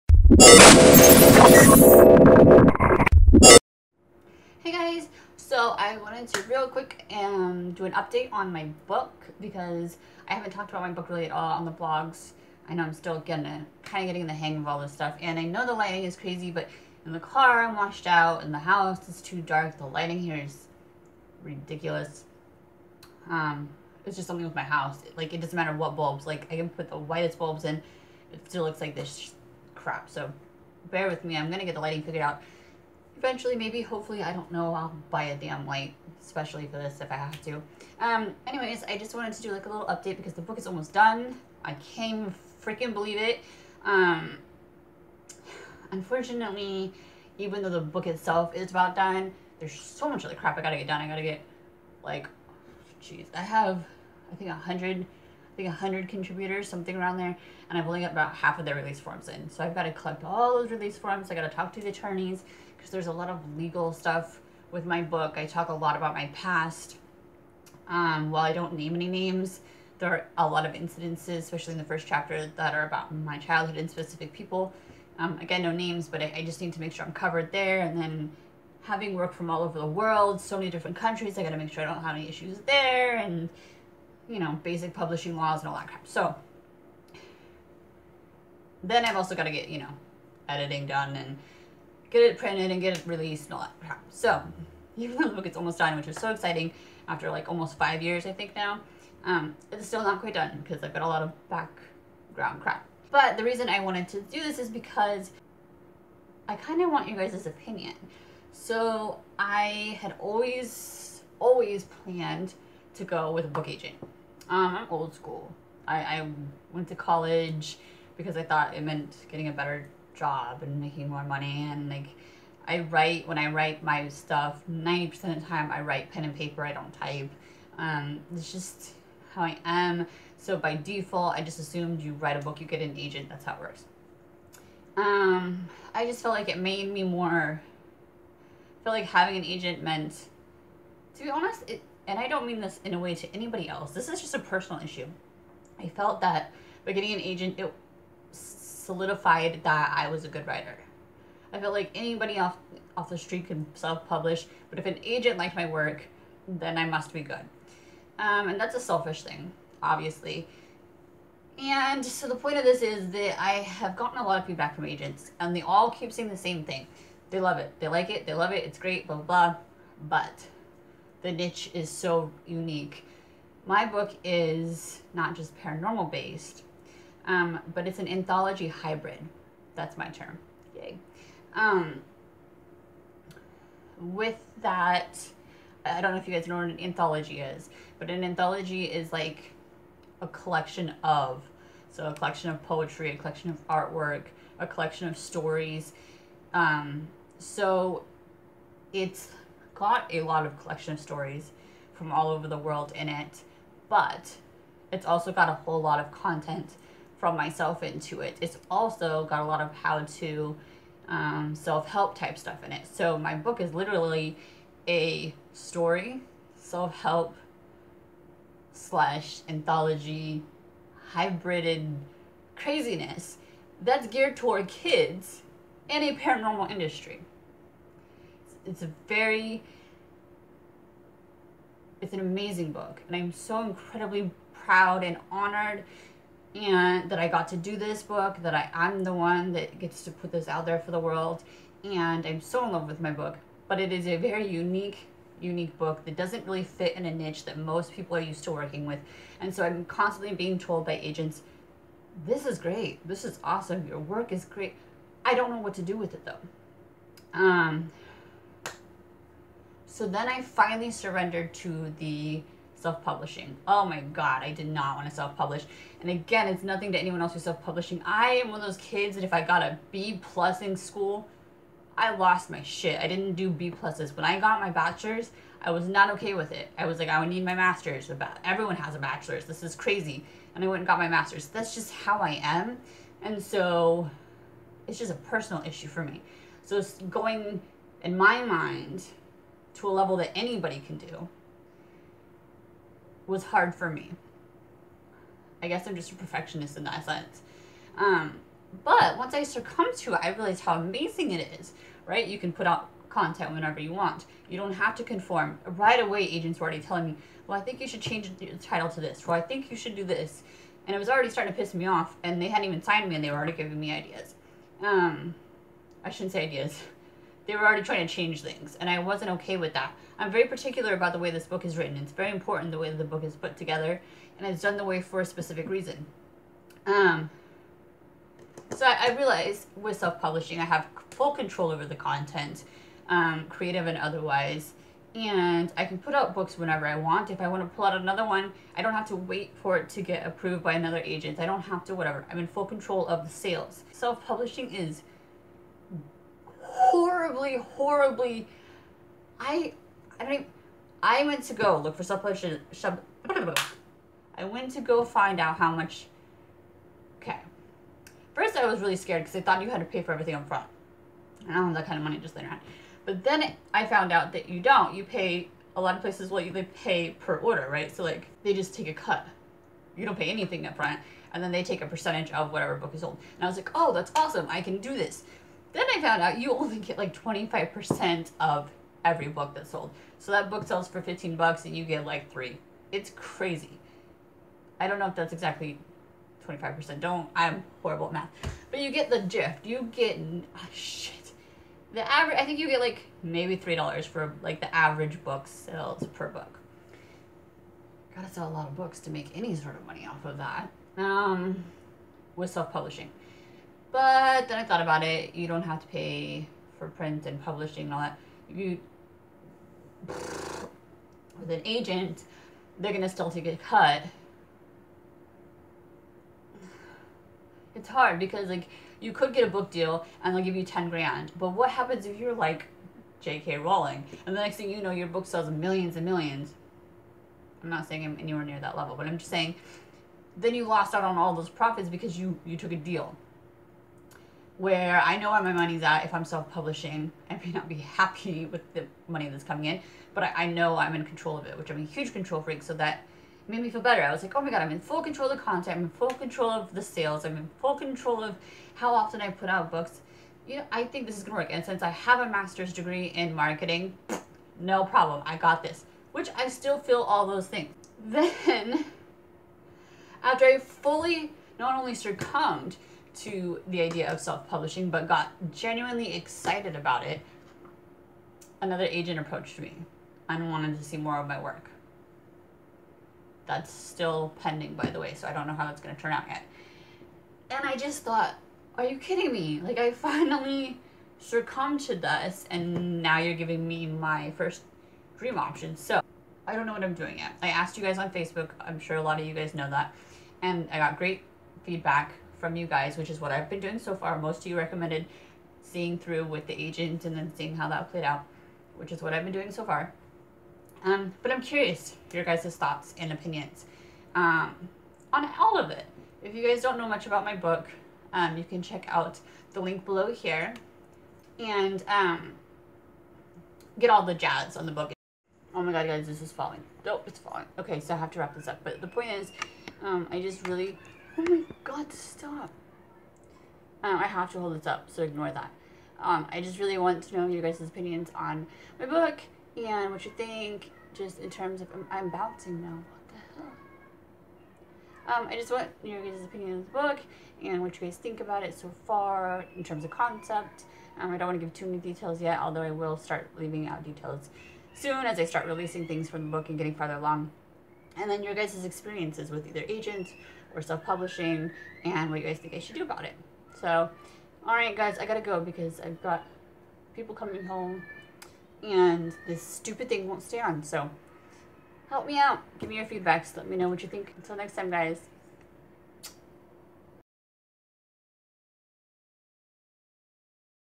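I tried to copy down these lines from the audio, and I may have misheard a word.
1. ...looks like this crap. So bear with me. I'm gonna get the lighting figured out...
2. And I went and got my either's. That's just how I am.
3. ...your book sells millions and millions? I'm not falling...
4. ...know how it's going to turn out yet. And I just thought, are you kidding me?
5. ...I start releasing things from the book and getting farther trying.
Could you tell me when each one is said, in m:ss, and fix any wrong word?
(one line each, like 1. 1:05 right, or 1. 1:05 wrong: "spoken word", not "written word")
1. 0:28 right
2. 4:40 wrong: "master", not "either"
3. 7:04 wrong: "saying", not "falling"
4. 7:55 right
5. 9:05 wrong: "along", not "trying".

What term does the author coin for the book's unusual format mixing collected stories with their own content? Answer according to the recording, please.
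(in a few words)
anthology hybrid.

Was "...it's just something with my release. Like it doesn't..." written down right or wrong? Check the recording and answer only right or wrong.
wrong.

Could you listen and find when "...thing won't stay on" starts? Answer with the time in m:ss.
9:19.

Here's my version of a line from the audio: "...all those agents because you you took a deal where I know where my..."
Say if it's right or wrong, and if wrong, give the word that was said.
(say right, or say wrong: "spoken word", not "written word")
wrong: "profits", not "agents".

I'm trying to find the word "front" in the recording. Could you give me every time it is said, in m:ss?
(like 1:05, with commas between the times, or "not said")
6:00, 6:10.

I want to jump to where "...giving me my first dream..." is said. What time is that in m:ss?
8:03.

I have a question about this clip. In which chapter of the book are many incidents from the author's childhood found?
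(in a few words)
First chapter.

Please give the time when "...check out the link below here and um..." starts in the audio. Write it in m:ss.
8:28.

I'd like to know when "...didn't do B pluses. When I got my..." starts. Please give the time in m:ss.
4:33.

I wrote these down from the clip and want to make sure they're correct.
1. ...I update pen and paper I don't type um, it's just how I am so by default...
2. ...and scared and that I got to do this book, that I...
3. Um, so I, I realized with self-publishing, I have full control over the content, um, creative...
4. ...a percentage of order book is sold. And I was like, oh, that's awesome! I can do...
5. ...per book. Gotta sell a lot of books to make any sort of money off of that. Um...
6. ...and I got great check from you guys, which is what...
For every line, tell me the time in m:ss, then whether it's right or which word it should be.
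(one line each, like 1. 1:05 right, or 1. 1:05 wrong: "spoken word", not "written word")
1. 2:05 wrong: "write", not "update"
2. 3:55 wrong: "honored", not "scared"
3. 5:26 right
4. 6:11 wrong: "whatever", not "order"
5. 6:36 right
6. 8:10 wrong: "feedback", not "check".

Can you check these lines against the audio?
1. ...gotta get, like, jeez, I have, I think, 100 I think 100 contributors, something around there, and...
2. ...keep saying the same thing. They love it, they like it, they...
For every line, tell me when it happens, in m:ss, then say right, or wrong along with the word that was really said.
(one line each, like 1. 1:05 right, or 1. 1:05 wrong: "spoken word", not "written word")
1. 0:51 right
2. 2:45 right.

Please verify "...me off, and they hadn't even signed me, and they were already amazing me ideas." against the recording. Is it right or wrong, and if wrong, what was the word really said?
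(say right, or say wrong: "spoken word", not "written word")
wrong: "giving", not "amazing".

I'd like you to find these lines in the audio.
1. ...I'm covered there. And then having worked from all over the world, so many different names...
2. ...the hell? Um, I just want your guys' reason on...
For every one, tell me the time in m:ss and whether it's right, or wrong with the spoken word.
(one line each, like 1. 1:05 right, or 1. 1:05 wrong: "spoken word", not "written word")
1. 1:17 wrong: "countries", not "names"
2. 8:53 wrong: "opinion", not "reason".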